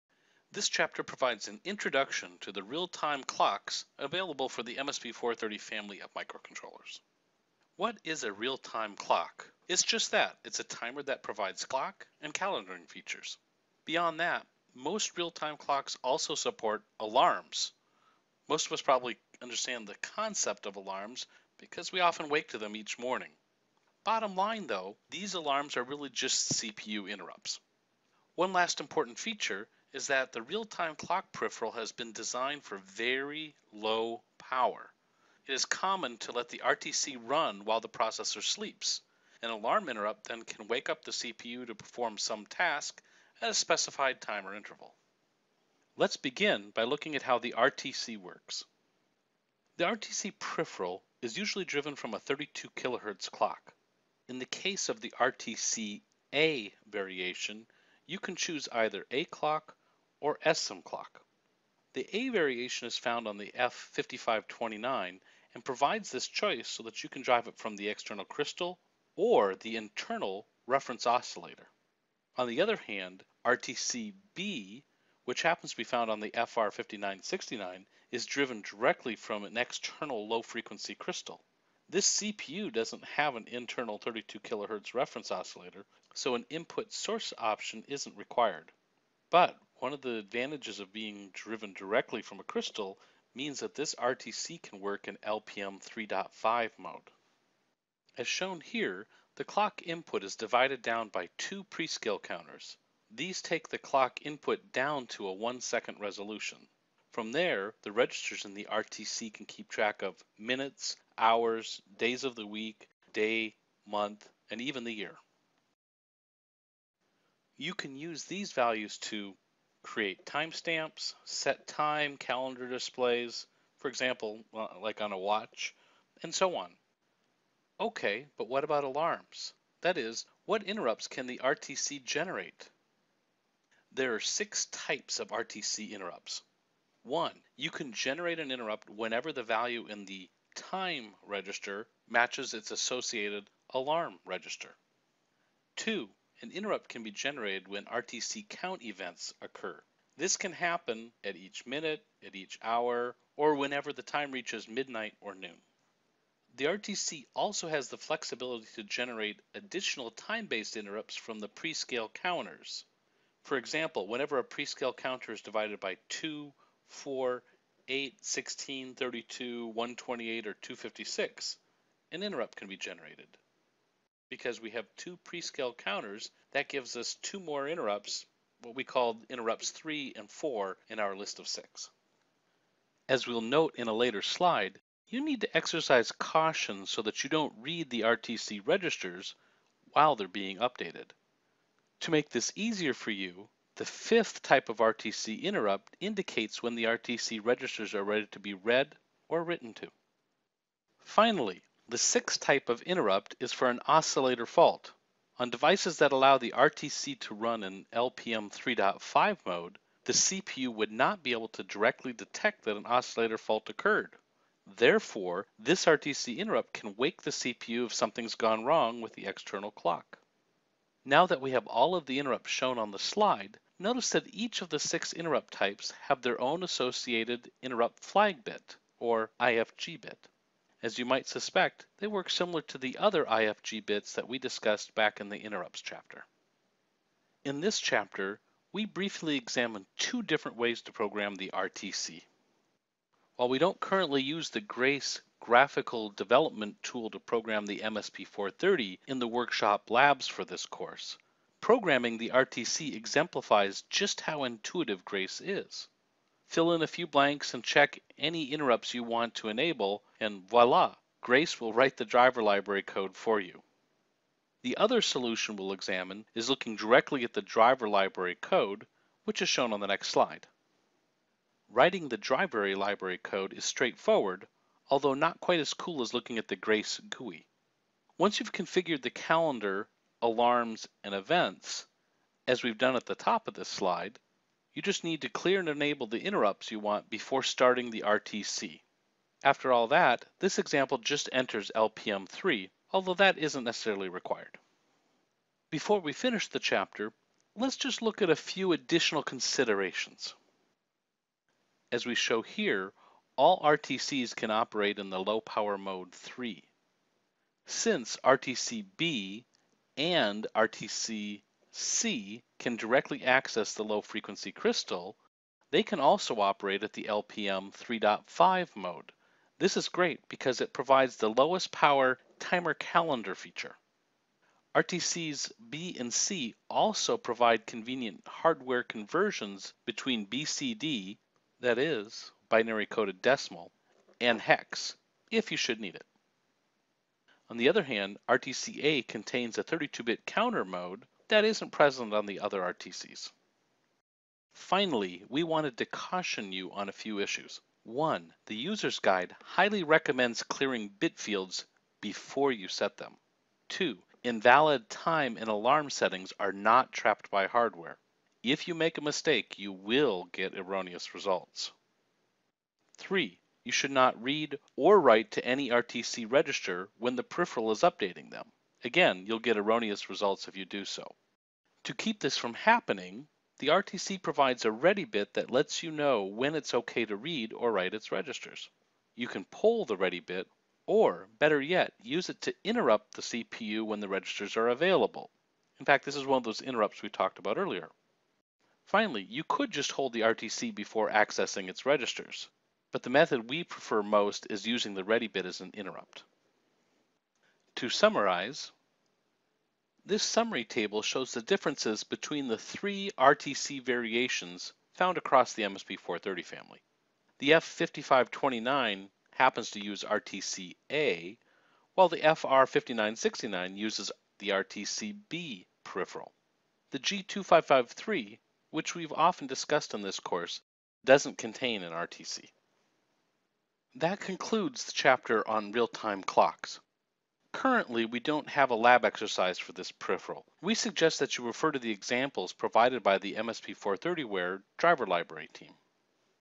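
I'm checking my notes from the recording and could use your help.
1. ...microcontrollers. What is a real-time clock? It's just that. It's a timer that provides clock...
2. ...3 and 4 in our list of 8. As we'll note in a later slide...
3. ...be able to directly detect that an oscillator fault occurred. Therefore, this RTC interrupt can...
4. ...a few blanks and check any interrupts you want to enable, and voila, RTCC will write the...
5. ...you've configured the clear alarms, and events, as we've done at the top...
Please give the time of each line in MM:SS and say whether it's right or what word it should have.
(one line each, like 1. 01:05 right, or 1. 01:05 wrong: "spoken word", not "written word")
1. 00:06 right
2. 02:59 wrong: "6", not "8"
3. 03:31 right
4. 04:16 wrong: "Grace", not "RTCC"
5. 04:38 wrong: "calendar", not "clear".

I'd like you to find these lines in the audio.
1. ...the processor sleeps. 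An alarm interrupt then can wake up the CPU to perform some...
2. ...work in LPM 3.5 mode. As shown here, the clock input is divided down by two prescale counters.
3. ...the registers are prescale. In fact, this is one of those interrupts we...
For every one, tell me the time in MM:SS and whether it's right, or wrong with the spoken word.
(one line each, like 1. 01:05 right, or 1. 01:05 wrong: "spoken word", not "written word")
1. 00:37 right
2. 01:34 right
3. 06:23 wrong: "available", not "prescale".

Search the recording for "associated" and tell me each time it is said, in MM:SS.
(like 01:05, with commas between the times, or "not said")
02:22, 03:46.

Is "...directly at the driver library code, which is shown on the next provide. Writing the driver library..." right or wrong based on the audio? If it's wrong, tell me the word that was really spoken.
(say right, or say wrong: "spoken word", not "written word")
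wrong: "slide", not "provide".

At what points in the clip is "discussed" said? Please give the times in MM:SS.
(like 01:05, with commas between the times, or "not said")
03:54, 06:59.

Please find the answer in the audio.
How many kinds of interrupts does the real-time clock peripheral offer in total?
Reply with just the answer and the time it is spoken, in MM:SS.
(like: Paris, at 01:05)
6, at 02:14.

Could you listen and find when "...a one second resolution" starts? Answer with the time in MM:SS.
01:45.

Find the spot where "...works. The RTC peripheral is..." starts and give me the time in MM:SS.
00:48.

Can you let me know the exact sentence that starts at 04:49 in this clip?
After all that, this example just enters LPM3, although that isn't necessarily required.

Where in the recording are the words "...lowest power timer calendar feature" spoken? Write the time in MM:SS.
05:21.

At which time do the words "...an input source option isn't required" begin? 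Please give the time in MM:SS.
01:26.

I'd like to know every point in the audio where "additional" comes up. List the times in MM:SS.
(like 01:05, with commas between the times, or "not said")
02:39, 04:58.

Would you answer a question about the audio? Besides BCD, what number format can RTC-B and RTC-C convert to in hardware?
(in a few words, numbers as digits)
hex.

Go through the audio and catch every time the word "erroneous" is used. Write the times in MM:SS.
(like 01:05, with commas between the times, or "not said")
06:00, 06:09.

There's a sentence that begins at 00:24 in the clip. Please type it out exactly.
Bottom line though, these alarms are really just CPU interrupts.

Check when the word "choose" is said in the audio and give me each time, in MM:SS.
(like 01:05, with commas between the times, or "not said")
00:58.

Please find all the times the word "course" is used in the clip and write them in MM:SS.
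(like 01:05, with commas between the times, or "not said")
04:10, 07:00.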